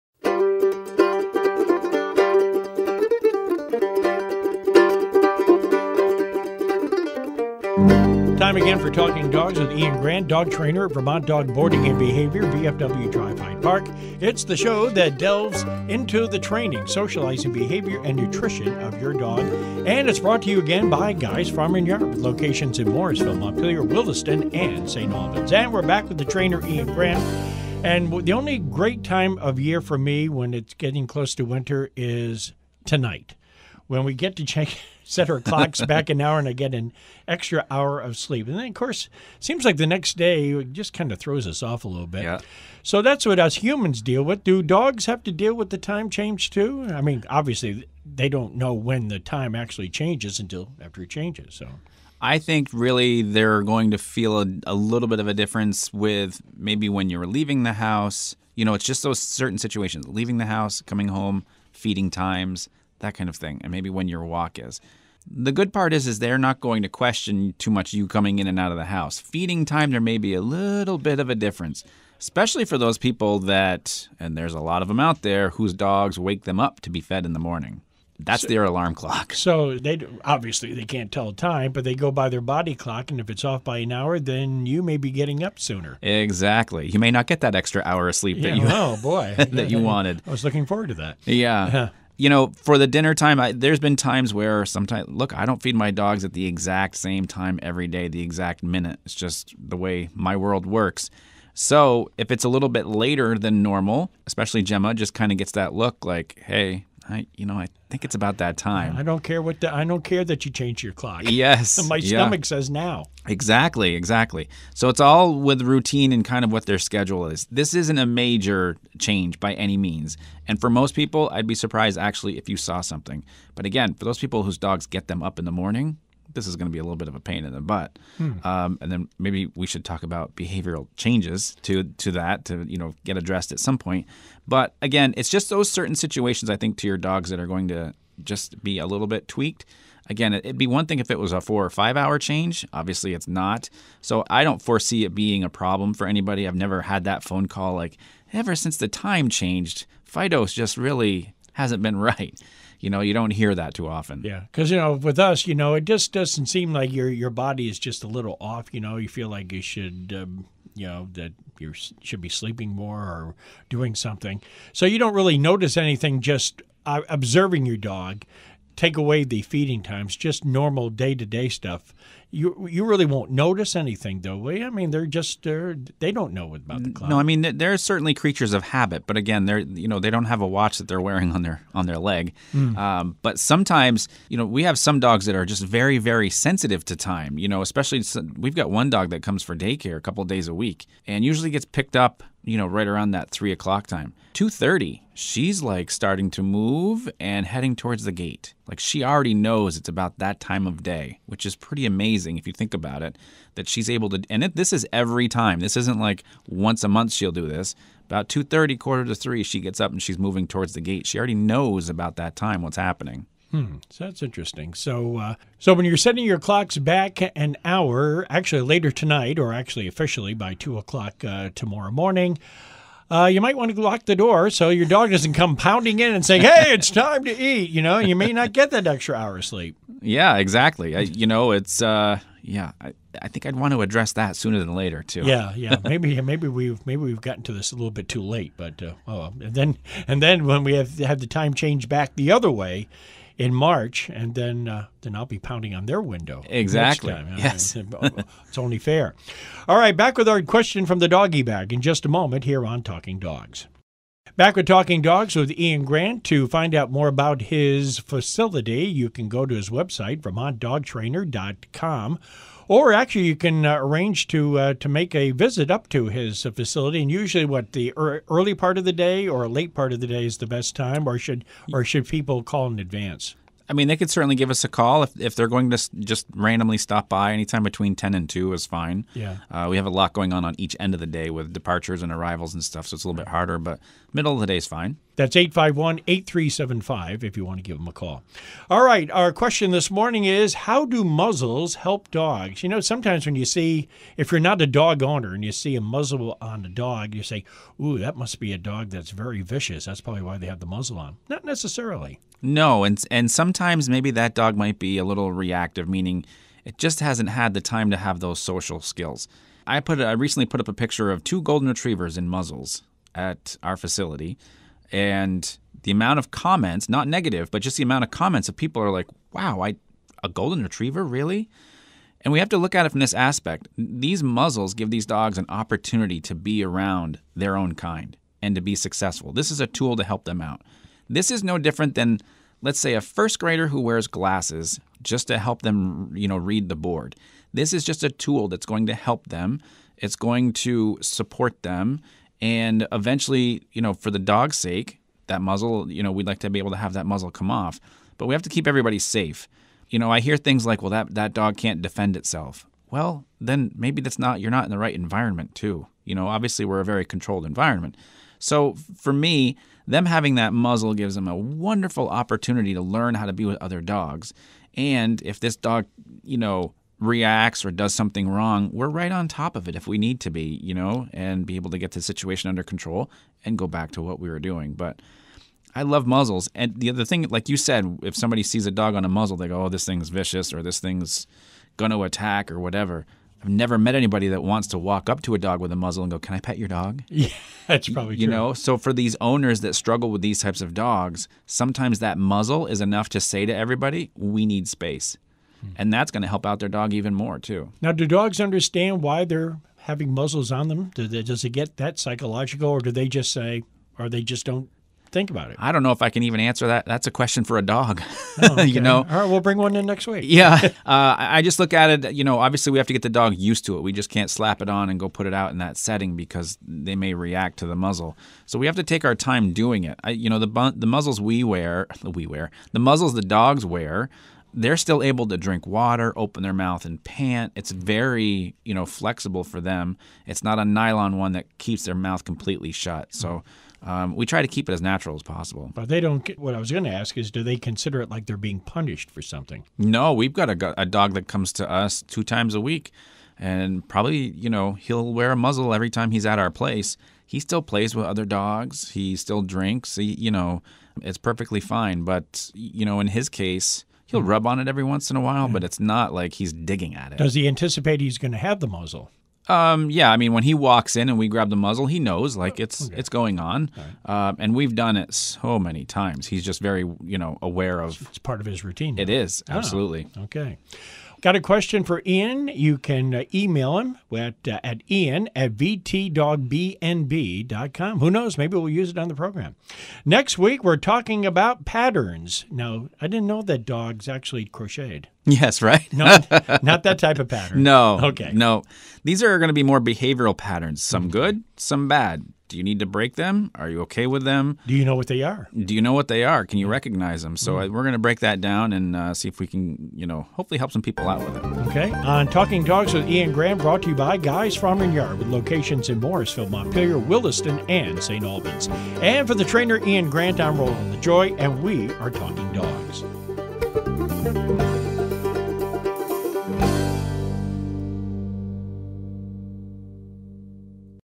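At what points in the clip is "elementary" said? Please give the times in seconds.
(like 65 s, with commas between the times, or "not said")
not said.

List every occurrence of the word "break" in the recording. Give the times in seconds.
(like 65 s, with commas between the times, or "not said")
492 s, 497 s.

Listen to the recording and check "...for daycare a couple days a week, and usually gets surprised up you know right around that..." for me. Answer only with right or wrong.
wrong.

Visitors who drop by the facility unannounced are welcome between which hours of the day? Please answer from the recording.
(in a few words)
10 and 2.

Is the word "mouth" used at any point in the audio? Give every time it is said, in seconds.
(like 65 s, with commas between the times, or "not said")
426 s, 431 s.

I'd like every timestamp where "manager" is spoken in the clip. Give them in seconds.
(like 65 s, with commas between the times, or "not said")
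not said.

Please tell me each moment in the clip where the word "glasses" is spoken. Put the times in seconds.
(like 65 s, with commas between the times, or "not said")
334 s.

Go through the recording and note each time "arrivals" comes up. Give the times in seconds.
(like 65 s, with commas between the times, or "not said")
282 s.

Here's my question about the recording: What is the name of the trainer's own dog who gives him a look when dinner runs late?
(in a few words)
Gemma.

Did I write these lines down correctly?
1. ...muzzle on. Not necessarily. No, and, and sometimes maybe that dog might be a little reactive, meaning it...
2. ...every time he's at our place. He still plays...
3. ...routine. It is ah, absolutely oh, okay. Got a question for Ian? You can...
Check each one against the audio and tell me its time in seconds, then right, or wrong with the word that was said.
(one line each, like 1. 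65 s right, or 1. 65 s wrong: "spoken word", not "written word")
1. 300 s right
2. 445 s right
3. 468 s right.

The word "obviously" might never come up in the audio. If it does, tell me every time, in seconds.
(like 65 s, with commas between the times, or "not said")
47 s, 80 s, 142 s, 356 s, 412 s.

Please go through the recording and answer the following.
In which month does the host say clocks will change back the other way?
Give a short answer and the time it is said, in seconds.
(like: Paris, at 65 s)
March, at 243 s.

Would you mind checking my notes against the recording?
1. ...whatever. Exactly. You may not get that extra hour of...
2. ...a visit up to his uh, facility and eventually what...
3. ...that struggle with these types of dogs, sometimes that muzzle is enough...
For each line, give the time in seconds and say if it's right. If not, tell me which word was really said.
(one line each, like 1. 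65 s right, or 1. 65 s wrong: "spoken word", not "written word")
1. 85 s wrong: "sooner", not "whatever"
2. 265 s wrong: "usually", not "eventually"
3. 389 s right.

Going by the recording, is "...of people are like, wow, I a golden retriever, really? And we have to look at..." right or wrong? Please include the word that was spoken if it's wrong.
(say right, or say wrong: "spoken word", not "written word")
right.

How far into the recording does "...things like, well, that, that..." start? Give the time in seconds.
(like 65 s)
350 s.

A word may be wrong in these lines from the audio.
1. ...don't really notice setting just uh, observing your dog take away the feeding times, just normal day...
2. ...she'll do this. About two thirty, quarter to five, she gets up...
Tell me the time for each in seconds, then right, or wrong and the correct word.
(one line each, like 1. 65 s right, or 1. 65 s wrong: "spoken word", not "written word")
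1. 164 s wrong: "anything", not "setting"
2. 207 s wrong: "three", not "five".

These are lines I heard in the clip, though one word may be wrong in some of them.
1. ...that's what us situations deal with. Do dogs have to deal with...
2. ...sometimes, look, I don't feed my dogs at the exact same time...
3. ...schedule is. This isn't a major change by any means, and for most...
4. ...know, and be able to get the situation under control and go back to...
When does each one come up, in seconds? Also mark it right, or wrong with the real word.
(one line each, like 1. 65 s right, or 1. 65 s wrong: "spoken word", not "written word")
1. 43 s wrong: "humans", not "situations"
2. 94 s right
3. 116 s right
4. 370 s right.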